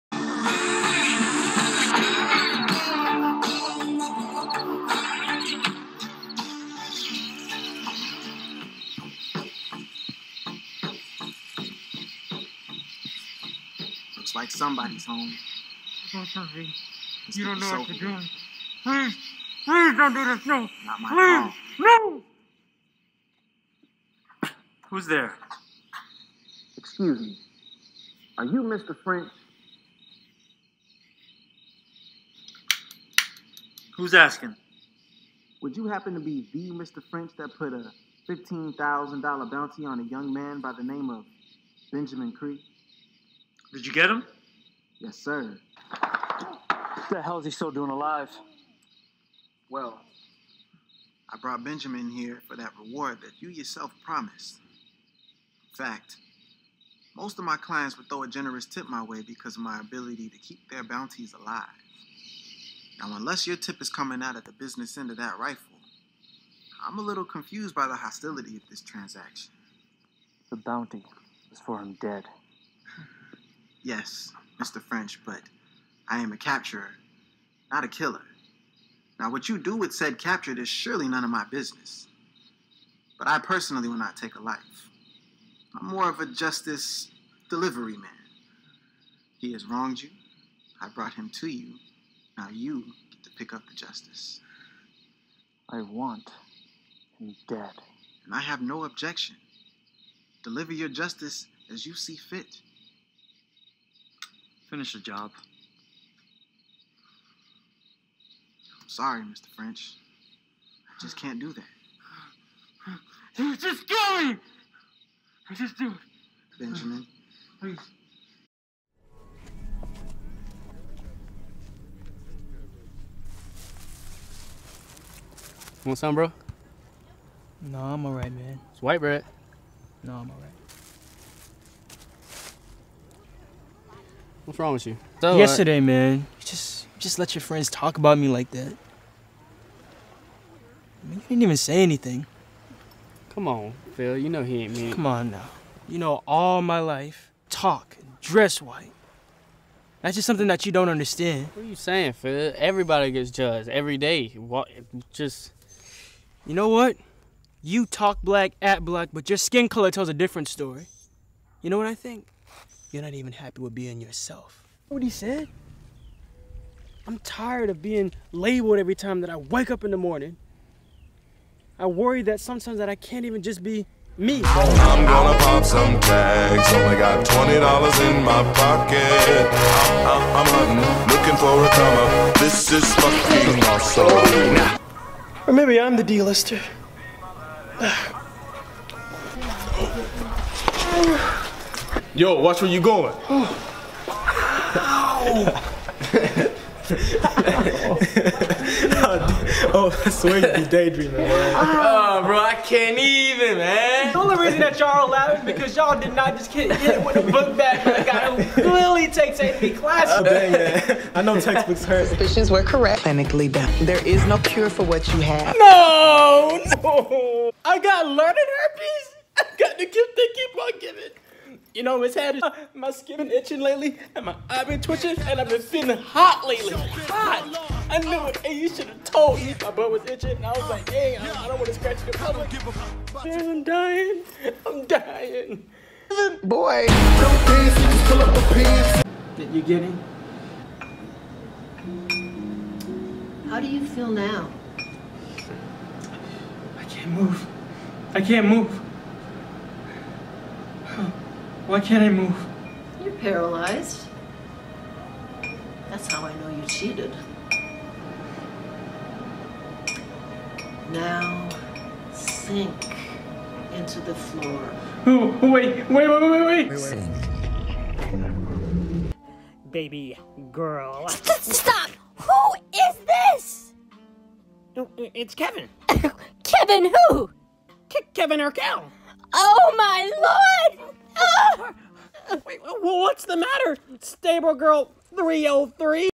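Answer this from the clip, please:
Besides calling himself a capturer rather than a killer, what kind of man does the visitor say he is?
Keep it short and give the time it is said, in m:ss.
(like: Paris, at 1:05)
justice delivery man, at 1:26.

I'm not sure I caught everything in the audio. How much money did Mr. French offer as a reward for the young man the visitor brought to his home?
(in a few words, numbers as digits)
$15,000.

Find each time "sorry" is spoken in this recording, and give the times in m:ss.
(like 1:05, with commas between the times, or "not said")
1:48.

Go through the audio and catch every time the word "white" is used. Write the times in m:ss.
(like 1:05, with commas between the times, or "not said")
2:08, 2:28.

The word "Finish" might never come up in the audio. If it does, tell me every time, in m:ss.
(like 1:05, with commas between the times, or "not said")
1:44.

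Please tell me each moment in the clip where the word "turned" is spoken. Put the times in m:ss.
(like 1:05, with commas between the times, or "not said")
not said.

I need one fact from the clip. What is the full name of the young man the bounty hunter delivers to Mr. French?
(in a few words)
Benjamin Creek.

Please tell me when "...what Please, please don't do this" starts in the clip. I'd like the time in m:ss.
0:17.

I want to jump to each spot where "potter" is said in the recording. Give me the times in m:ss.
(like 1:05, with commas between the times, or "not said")
not said.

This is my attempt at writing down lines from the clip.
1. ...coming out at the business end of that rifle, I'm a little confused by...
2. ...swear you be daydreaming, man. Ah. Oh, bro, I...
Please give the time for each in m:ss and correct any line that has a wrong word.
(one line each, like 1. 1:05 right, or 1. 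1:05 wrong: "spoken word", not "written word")
1. 1:03 right
2. 3:20 right.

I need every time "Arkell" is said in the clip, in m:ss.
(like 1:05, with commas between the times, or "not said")
4:38.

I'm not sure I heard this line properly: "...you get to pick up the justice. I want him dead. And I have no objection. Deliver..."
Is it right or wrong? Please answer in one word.
right.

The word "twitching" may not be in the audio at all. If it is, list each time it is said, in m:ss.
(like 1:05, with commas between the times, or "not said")
3:44.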